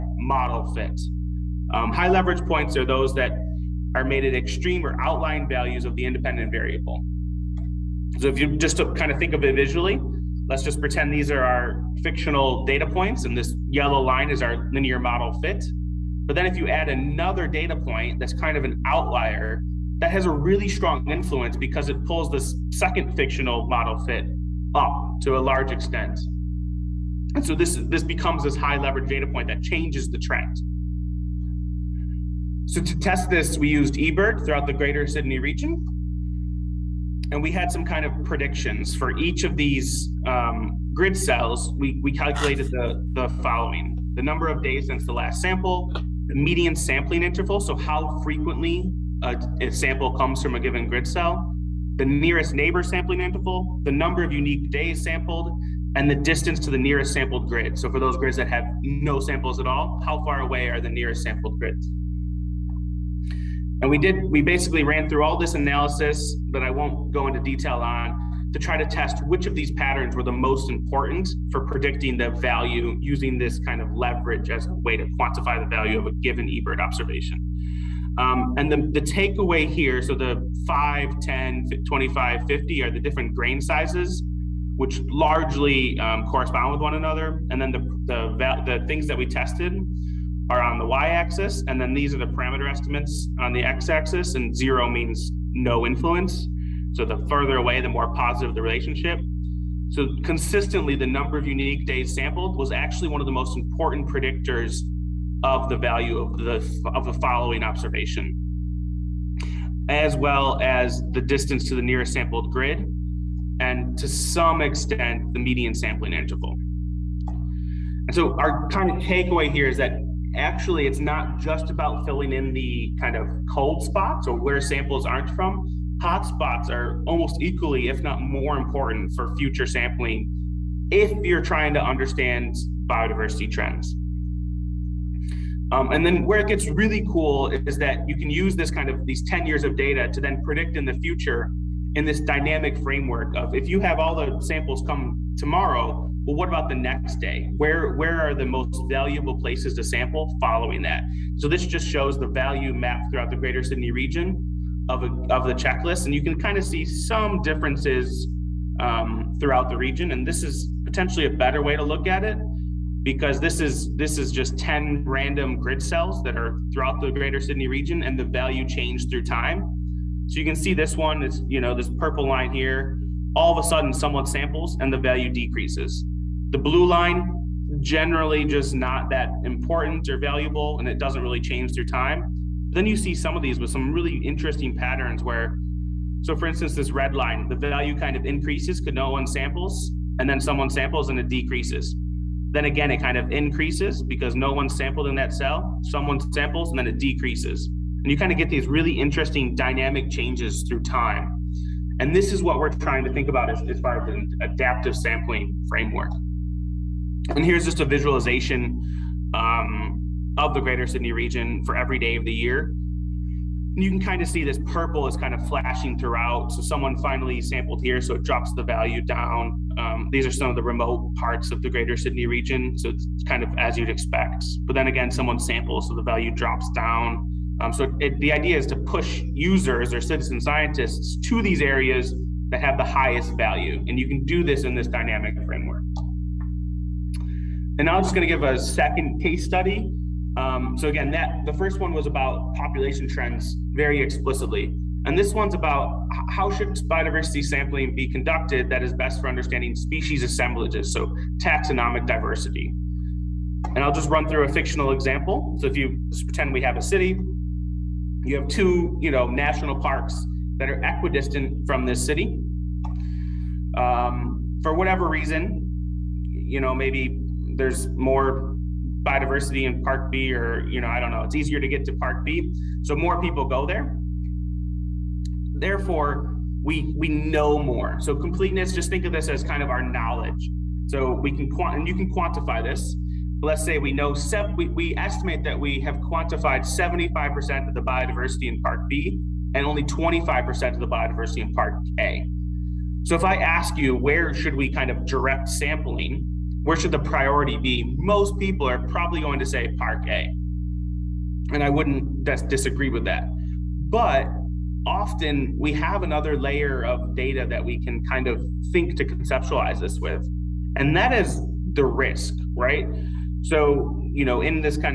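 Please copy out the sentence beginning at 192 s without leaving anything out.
Then again, it kind of increases because no one sampled in that cell, someone samples, and then it decreases.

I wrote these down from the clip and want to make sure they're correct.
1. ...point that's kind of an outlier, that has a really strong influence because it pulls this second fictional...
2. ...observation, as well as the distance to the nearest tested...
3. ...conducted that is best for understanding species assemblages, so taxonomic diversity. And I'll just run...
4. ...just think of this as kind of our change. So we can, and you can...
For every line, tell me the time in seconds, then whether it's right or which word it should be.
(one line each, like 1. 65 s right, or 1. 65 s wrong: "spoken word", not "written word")
1. 17 s right
2. 107 s wrong: "sampled", not "tested"
3. 248 s right
4. 278 s wrong: "knowledge", not "change".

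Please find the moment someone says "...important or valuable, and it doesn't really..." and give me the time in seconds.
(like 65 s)
179 s.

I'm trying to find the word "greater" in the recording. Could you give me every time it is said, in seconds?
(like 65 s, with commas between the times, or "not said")
34 s, 153 s, 167 s, 210 s, 221 s.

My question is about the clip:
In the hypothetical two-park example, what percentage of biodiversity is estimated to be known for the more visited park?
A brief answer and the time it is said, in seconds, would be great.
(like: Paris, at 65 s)
75%, at 286 s.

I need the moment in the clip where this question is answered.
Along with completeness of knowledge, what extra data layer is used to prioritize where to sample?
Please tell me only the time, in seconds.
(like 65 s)
311 s.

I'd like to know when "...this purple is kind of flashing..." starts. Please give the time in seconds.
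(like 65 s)
214 s.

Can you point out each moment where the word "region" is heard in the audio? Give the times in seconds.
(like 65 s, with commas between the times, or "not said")
35 s, 153 s, 159 s, 167 s, 211 s, 222 s.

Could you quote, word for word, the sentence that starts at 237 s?
And now I'm just going to give a second case study.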